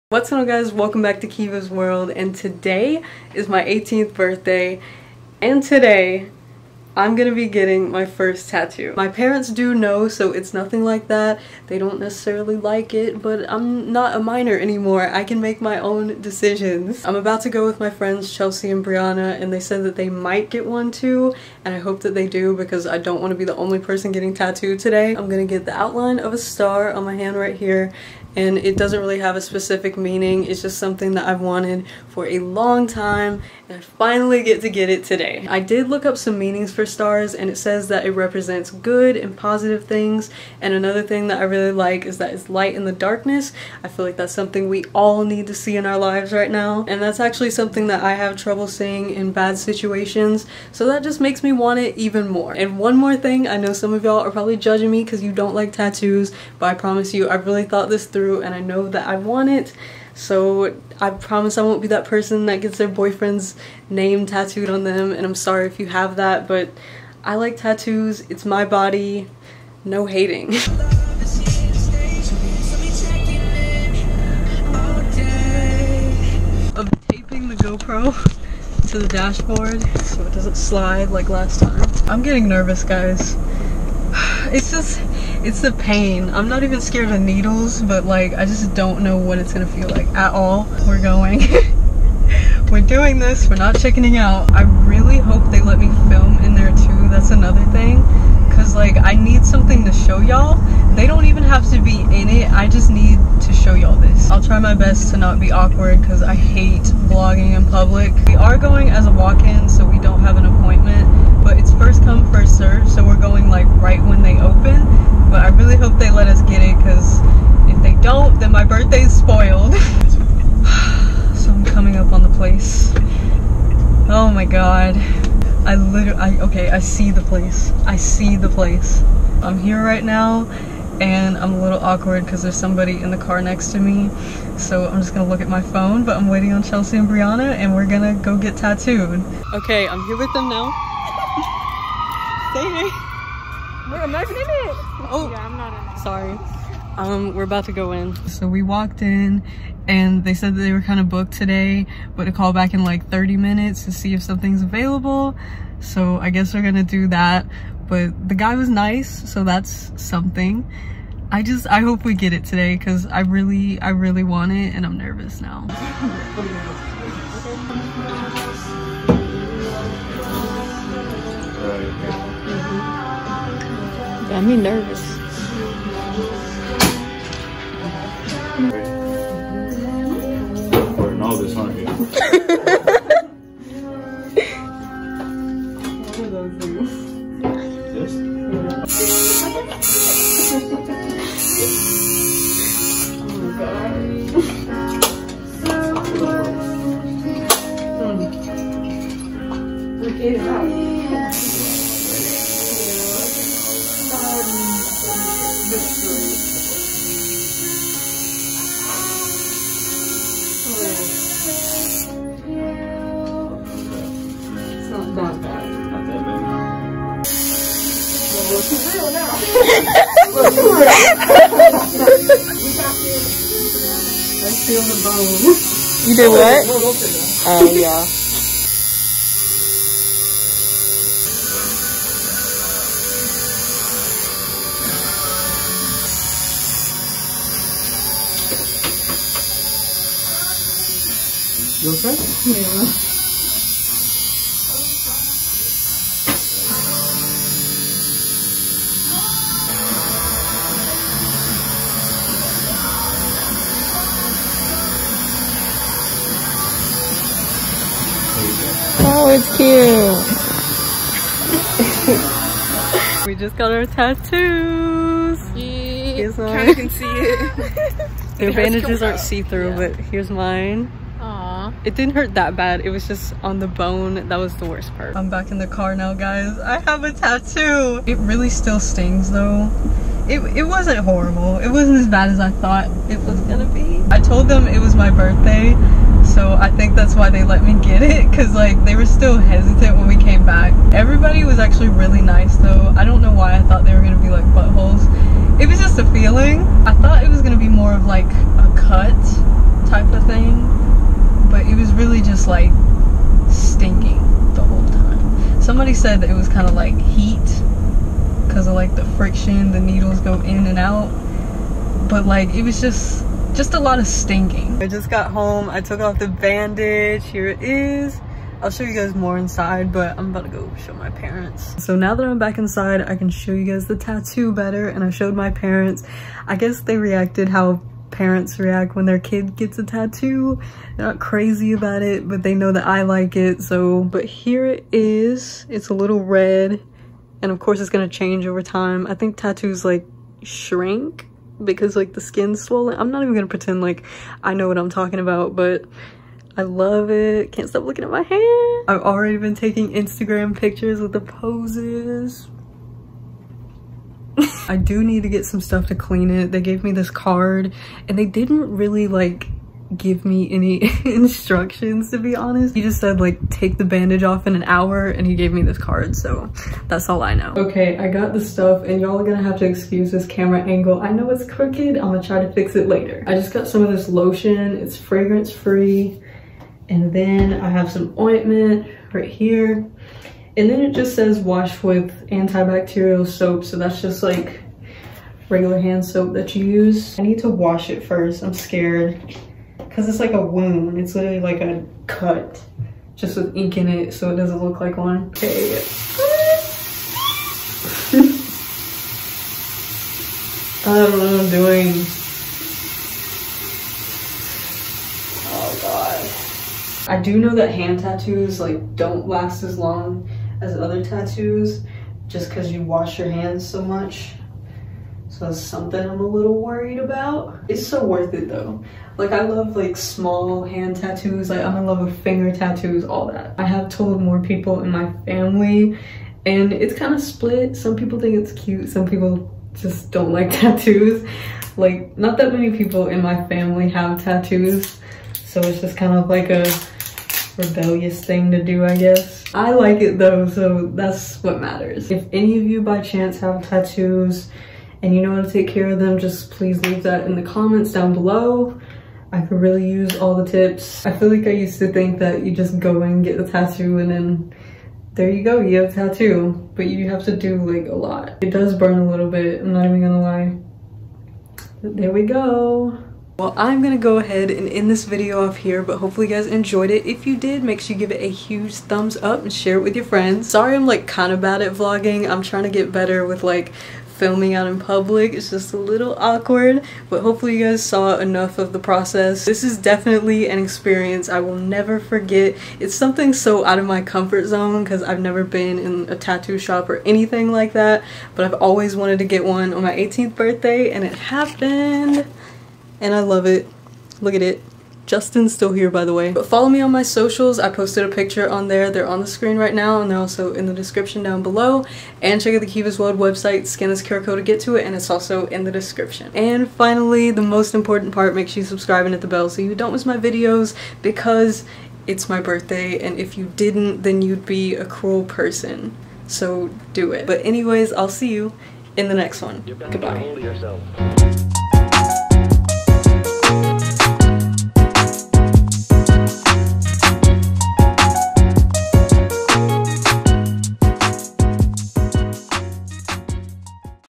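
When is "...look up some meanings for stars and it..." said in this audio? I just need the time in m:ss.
0:35.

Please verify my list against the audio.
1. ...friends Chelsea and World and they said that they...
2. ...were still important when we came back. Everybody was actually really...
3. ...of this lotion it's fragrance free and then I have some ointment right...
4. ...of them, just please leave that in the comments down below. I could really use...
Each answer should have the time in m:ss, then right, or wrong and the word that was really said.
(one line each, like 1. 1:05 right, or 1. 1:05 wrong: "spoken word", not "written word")
1. 0:17 wrong: "Brianna", not "World"
2. 4:48 wrong: "hesitant", not "important"
3. 6:13 right
4. 7:25 right.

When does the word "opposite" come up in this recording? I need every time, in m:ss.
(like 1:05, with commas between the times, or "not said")
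not said.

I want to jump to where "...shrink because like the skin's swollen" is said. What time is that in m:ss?
5:40.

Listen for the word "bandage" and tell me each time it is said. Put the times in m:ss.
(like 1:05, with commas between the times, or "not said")
4:28, 5:16, 6:03.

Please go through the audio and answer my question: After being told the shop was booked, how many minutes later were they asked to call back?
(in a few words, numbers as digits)
30.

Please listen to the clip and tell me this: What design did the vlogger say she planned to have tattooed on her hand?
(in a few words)
Outline of a star.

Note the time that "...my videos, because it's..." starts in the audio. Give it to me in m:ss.
8:30.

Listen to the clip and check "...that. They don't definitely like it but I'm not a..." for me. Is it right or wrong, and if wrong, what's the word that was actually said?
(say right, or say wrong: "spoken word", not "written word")
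wrong: "necessarily", not "definitely".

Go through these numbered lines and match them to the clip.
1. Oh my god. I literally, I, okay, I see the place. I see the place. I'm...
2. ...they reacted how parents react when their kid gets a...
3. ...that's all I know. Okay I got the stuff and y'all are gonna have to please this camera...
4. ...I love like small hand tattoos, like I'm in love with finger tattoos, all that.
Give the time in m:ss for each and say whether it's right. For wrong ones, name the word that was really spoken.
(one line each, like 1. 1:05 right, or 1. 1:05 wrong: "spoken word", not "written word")
1. 2:04 right
2. 5:26 right
3. 6:06 wrong: "excuse", not "please"
4. 6:59 right.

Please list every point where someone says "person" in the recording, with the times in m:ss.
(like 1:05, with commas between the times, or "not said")
0:23, 1:02, 8:35.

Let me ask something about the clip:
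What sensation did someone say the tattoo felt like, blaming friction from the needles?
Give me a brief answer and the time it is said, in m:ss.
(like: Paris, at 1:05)
Heat, at 5:06.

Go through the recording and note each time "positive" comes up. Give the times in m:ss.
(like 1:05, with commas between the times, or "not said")
0:39.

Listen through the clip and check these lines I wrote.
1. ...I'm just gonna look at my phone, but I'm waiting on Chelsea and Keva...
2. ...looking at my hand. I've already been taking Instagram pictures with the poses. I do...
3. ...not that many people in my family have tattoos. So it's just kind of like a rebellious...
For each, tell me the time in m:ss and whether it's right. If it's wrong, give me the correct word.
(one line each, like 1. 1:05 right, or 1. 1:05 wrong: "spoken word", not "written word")
1. 2:14 wrong: "Brianna", not "Keva"
2. 5:47 right
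3. 7:12 right.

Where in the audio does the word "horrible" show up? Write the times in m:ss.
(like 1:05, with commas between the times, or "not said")
4:40.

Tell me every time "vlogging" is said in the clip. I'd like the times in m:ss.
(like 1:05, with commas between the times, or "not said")
1:47, 7:51.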